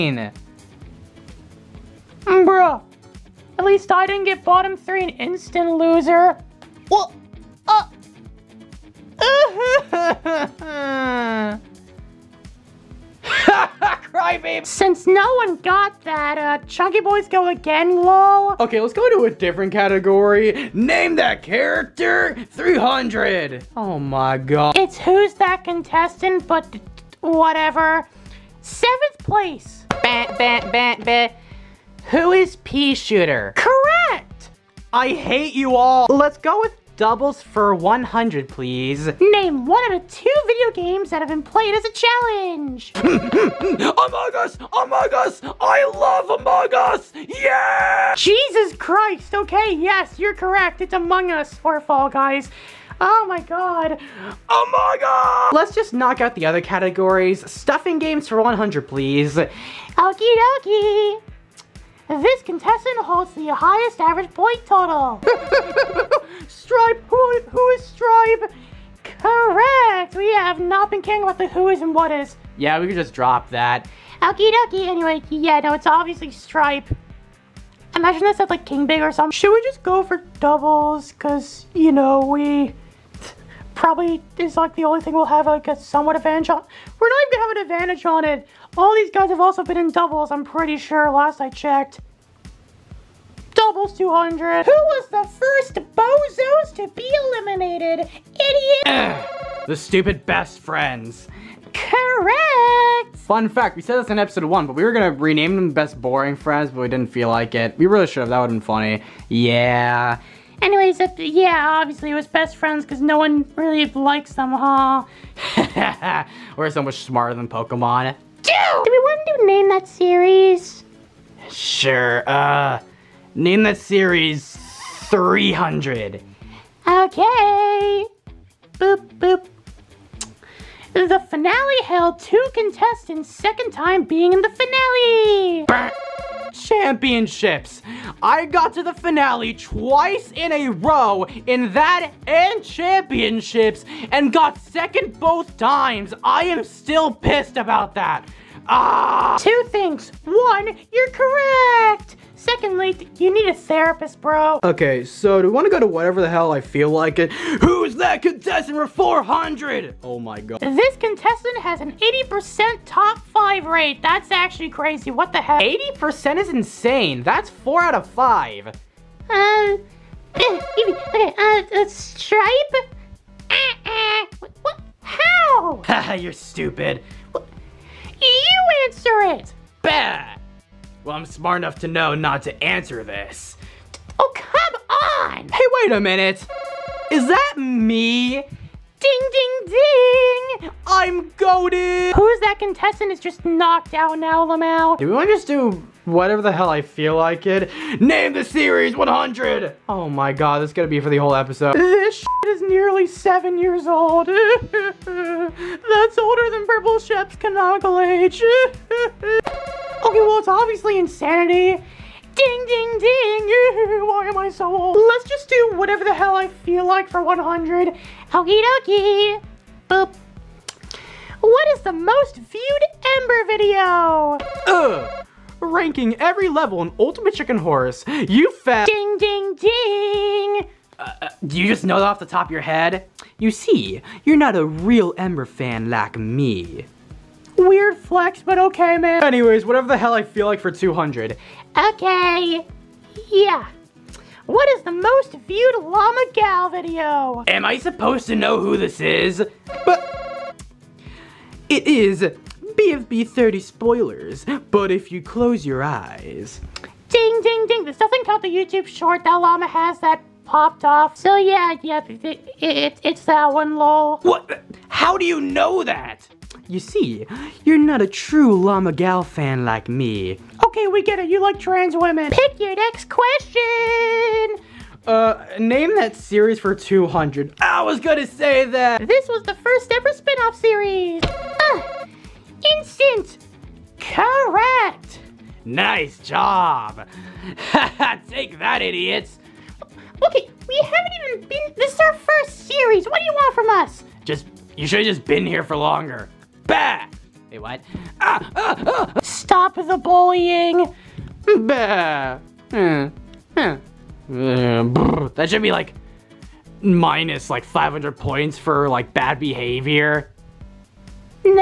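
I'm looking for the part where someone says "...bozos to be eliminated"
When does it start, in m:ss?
1:35.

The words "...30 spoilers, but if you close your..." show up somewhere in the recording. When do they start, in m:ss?
4:13.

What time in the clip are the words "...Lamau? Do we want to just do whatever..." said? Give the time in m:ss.
3:14.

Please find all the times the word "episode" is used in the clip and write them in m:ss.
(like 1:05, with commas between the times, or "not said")
1:44, 3:21.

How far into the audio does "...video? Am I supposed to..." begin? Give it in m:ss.
4:06.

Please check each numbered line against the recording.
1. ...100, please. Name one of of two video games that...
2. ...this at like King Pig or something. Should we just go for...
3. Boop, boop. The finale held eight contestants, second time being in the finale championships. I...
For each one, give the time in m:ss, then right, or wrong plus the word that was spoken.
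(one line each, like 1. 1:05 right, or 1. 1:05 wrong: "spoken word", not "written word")
1. 0:37 right
2. 1:18 right
3. 2:08 wrong: "two", not "eight".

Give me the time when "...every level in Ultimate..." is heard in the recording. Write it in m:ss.
3:46.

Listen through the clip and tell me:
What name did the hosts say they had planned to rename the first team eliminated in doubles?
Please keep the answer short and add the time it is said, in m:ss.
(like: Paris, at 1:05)
Best boring friends, at 1:45.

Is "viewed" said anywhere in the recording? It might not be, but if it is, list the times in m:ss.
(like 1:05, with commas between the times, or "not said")
3:42, 4:05.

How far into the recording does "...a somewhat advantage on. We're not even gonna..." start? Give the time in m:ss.
1:25.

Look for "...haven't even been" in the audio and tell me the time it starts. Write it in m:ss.
4:50.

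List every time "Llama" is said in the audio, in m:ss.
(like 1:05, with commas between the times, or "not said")
4:05, 4:19, 4:28.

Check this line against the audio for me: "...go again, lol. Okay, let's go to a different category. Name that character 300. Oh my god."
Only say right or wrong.
right.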